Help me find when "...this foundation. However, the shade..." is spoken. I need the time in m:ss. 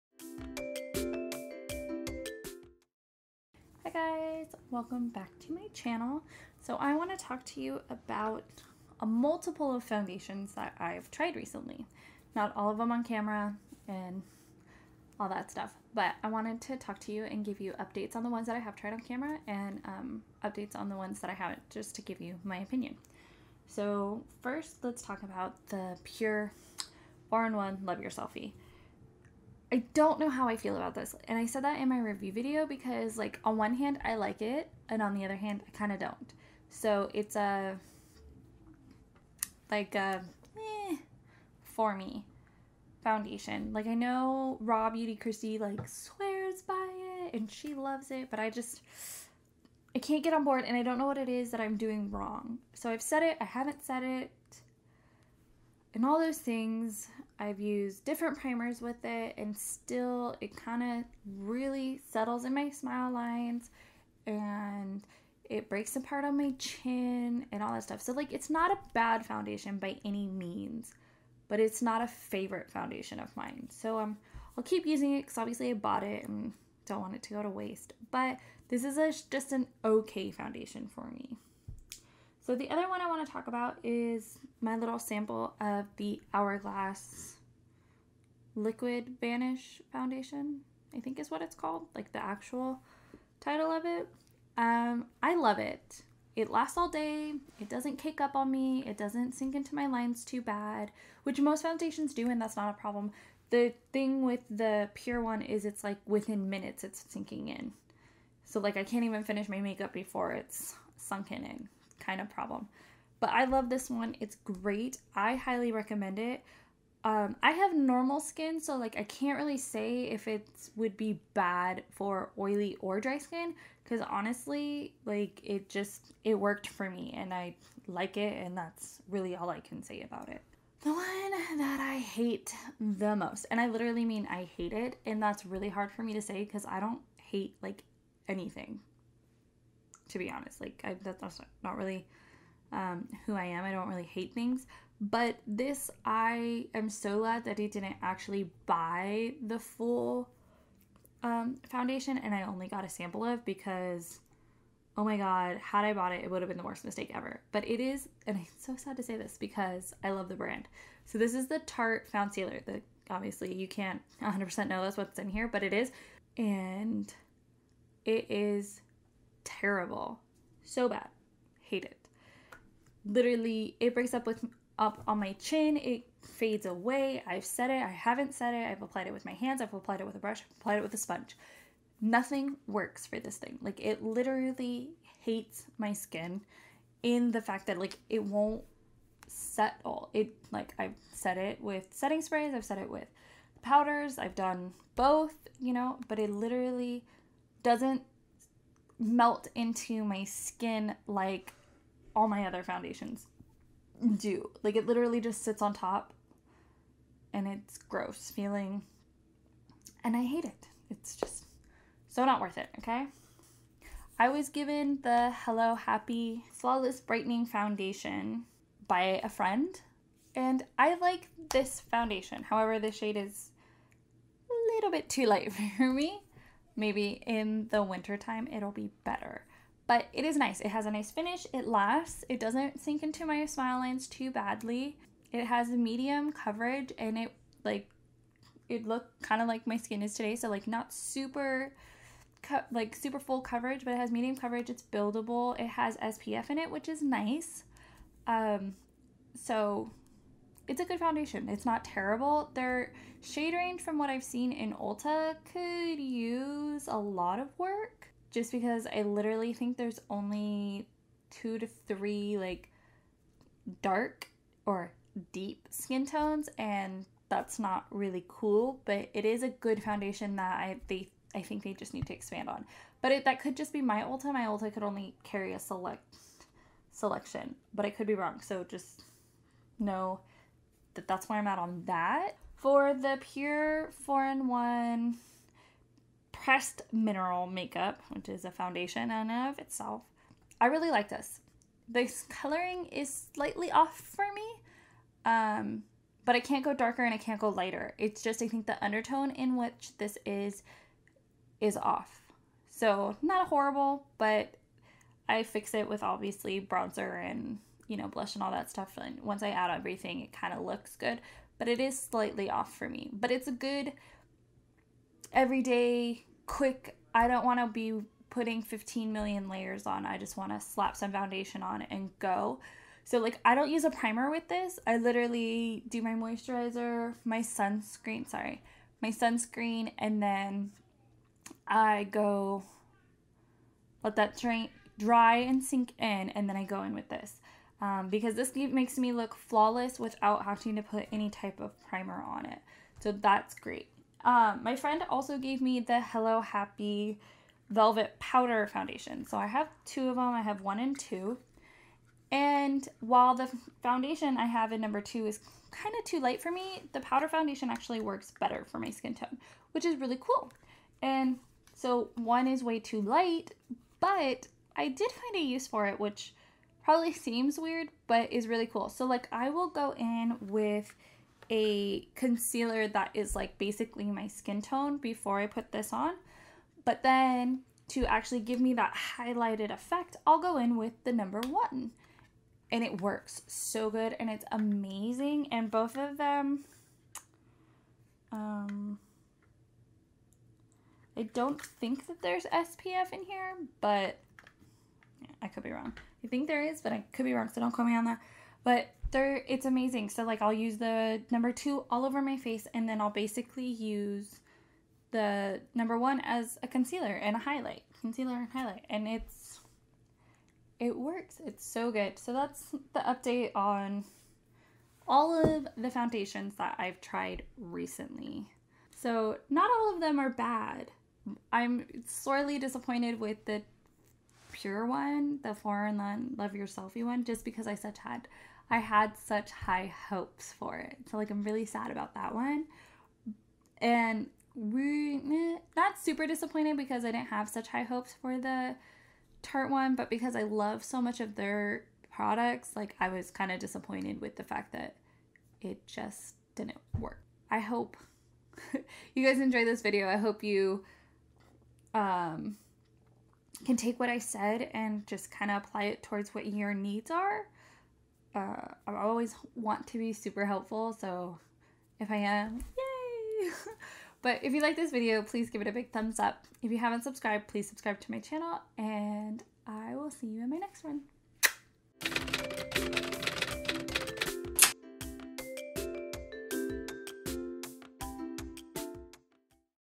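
3:41.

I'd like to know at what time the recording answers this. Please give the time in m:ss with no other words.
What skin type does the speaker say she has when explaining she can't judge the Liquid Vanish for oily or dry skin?
1:57.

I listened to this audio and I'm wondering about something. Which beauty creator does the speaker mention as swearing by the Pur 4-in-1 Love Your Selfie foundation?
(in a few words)
Raw Beauty Kristi.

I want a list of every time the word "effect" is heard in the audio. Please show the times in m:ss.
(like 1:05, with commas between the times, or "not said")
6:19.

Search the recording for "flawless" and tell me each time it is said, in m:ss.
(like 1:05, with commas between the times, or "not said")
3:36, 5:39.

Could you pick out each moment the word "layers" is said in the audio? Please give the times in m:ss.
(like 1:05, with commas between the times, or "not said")
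5:19.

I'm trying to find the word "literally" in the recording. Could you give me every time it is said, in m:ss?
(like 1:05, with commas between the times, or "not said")
2:13, 2:53, 3:04, 3:16, 3:24, 4:19, 5:24.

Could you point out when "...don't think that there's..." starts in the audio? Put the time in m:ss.
6:31.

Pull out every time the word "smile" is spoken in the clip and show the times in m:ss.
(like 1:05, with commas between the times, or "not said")
1:02, 3:53.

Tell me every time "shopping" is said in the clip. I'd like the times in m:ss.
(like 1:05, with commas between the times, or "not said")
not said.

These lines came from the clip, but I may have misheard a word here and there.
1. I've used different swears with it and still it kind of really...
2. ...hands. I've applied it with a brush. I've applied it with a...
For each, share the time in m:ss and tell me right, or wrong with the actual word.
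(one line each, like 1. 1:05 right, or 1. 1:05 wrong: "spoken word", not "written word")
1. 0:57 wrong: "primers", not "swears"
2. 2:59 right.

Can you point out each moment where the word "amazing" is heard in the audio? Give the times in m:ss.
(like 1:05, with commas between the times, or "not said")
6:24, 6:39.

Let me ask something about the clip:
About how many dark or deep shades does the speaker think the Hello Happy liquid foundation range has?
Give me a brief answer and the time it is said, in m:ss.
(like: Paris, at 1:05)
2 to 3, at 4:21.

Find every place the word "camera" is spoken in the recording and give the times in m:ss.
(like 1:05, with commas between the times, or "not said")
0:13, 0:19.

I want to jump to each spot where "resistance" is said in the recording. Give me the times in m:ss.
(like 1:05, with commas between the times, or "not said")
not said.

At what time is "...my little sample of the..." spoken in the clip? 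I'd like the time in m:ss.
1:24.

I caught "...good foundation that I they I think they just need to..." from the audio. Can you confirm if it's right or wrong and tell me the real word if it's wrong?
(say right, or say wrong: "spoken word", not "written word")
right.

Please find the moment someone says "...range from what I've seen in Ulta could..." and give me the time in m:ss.
4:13.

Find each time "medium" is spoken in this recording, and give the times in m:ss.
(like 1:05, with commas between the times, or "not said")
3:55, 4:04.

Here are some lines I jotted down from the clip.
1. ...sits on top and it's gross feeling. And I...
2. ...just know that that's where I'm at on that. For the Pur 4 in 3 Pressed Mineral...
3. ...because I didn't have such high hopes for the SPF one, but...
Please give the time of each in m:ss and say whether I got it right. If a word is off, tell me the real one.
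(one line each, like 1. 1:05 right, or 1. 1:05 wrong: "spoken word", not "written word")
1. 3:25 right
2. 4:38 wrong: "1", not "3"
3. 7:16 wrong: "Tarte", not "SPF".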